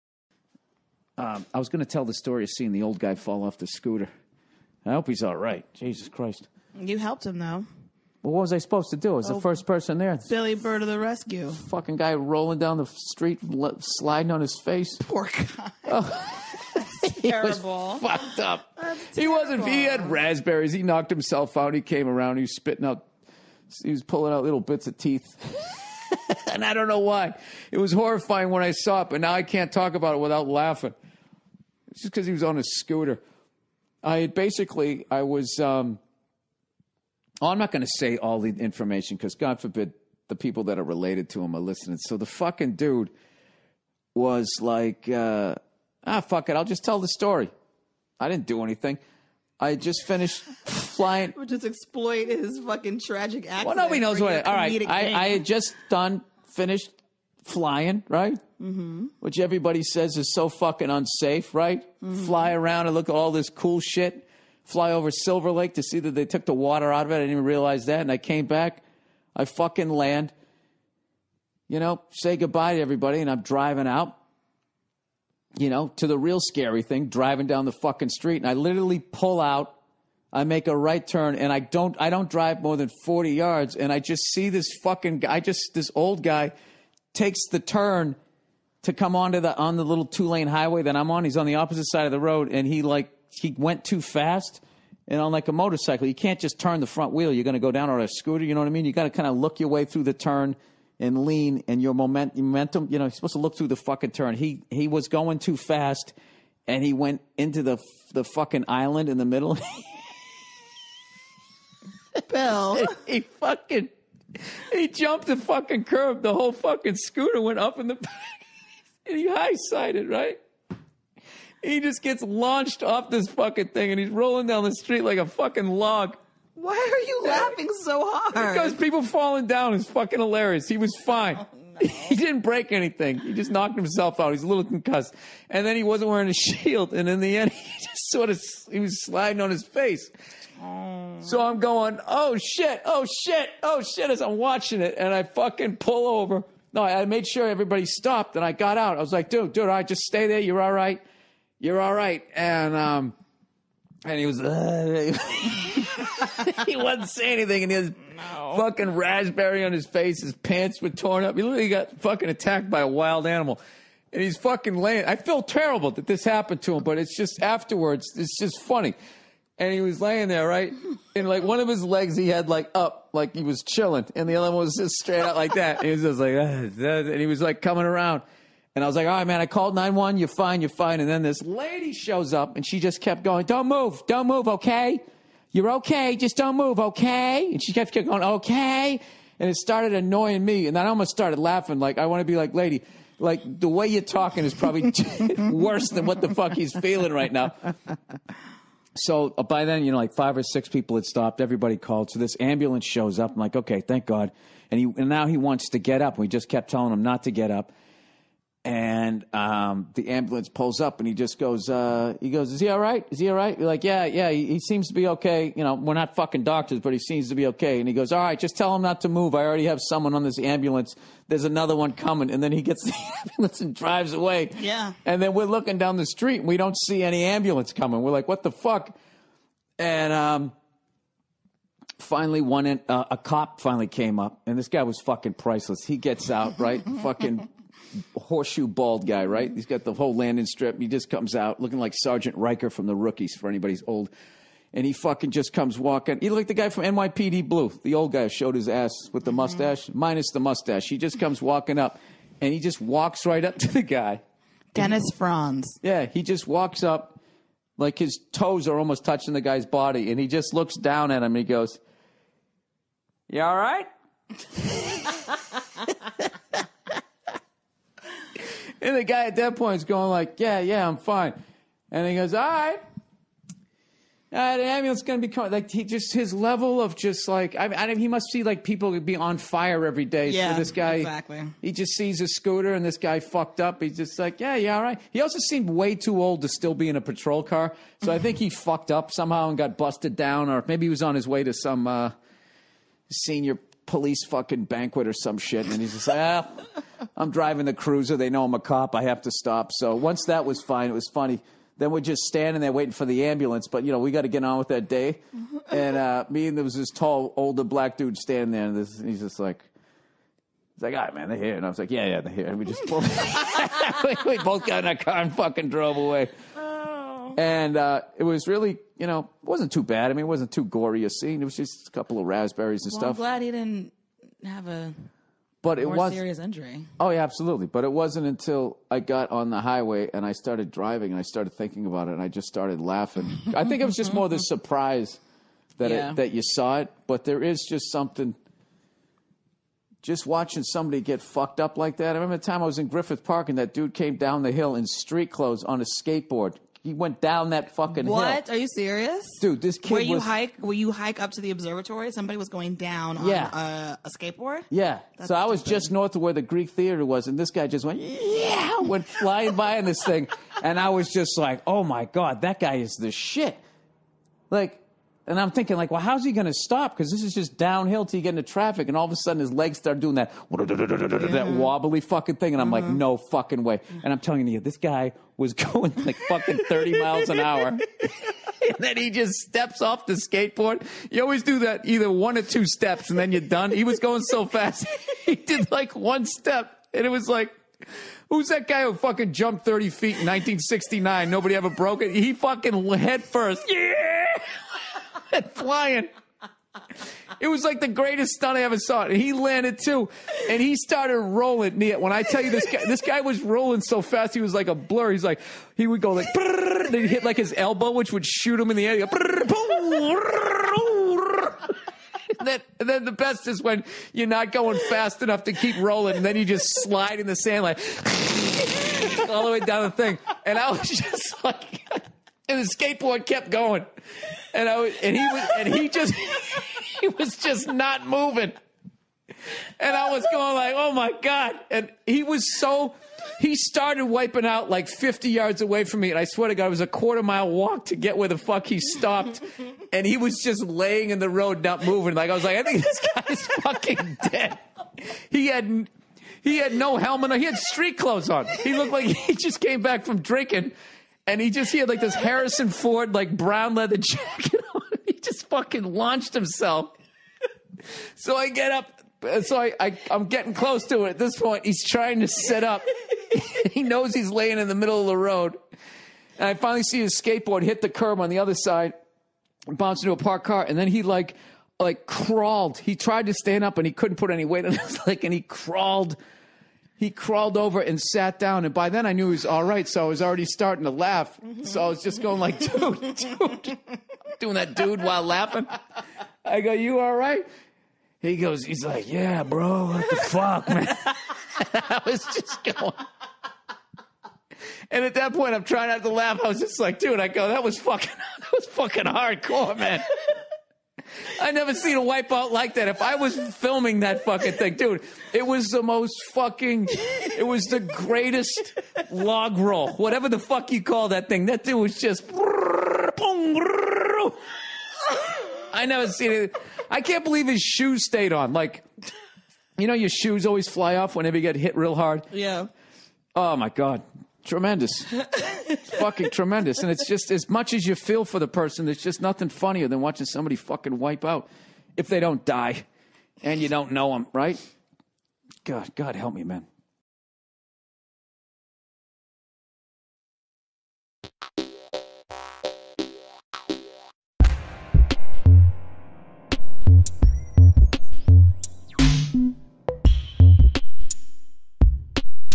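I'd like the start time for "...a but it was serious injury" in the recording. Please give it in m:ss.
5:24.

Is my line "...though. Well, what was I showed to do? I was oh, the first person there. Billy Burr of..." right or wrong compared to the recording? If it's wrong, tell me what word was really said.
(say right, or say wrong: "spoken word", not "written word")
wrong: "supposed", not "showed".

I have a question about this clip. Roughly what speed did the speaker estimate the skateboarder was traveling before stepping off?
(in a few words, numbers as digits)
30 miles an hour.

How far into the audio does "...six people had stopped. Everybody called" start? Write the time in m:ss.
3:20.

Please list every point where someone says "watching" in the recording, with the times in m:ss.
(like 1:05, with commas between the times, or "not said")
2:24, 5:40, 8:50.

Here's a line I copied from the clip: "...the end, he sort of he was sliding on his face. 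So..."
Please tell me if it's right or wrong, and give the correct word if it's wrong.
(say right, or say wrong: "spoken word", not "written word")
right.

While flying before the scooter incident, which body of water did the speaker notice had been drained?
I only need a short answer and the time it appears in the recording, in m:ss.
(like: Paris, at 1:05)
Silver Lake, at 1:05.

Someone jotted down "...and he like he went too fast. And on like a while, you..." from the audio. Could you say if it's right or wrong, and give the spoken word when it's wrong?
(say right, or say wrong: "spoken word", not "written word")
wrong: "motorcycle", not "while".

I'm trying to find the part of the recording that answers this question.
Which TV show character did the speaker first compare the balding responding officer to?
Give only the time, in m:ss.
4:01.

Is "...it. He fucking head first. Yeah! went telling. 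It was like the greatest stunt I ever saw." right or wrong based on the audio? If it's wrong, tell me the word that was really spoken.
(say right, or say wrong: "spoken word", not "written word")
wrong: "flying", not "telling".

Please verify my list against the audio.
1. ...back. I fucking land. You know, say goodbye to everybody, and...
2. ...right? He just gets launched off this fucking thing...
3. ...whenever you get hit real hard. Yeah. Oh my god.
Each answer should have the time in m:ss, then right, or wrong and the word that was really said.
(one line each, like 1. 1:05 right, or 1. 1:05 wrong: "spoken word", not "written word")
1. 1:08 right
2. 2:00 right
3. 8:41 right.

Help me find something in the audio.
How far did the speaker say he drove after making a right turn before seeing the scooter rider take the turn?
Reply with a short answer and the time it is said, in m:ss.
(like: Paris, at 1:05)
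40 yards, at 1:23.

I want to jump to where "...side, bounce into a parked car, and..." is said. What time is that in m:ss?
7:48.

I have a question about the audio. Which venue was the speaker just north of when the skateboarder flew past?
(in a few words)
the Greek Theater.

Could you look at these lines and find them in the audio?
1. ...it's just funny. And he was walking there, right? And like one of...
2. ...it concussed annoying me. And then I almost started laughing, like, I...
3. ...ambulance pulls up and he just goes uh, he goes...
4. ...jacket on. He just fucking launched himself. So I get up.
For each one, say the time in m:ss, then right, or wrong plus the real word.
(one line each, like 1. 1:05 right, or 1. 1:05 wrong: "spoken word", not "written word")
1. 2:48 wrong: "laying", not "walking"
2. 3:09 wrong: "started", not "concussed"
3. 3:30 right
4. 7:33 right.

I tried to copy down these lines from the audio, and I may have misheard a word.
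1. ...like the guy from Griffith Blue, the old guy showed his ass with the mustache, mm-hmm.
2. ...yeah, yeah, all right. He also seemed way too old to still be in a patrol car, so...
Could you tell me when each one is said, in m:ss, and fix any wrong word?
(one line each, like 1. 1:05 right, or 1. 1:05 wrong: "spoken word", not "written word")
1. 4:06 wrong: "NYPD", not "Griffith"
2. 4:44 right.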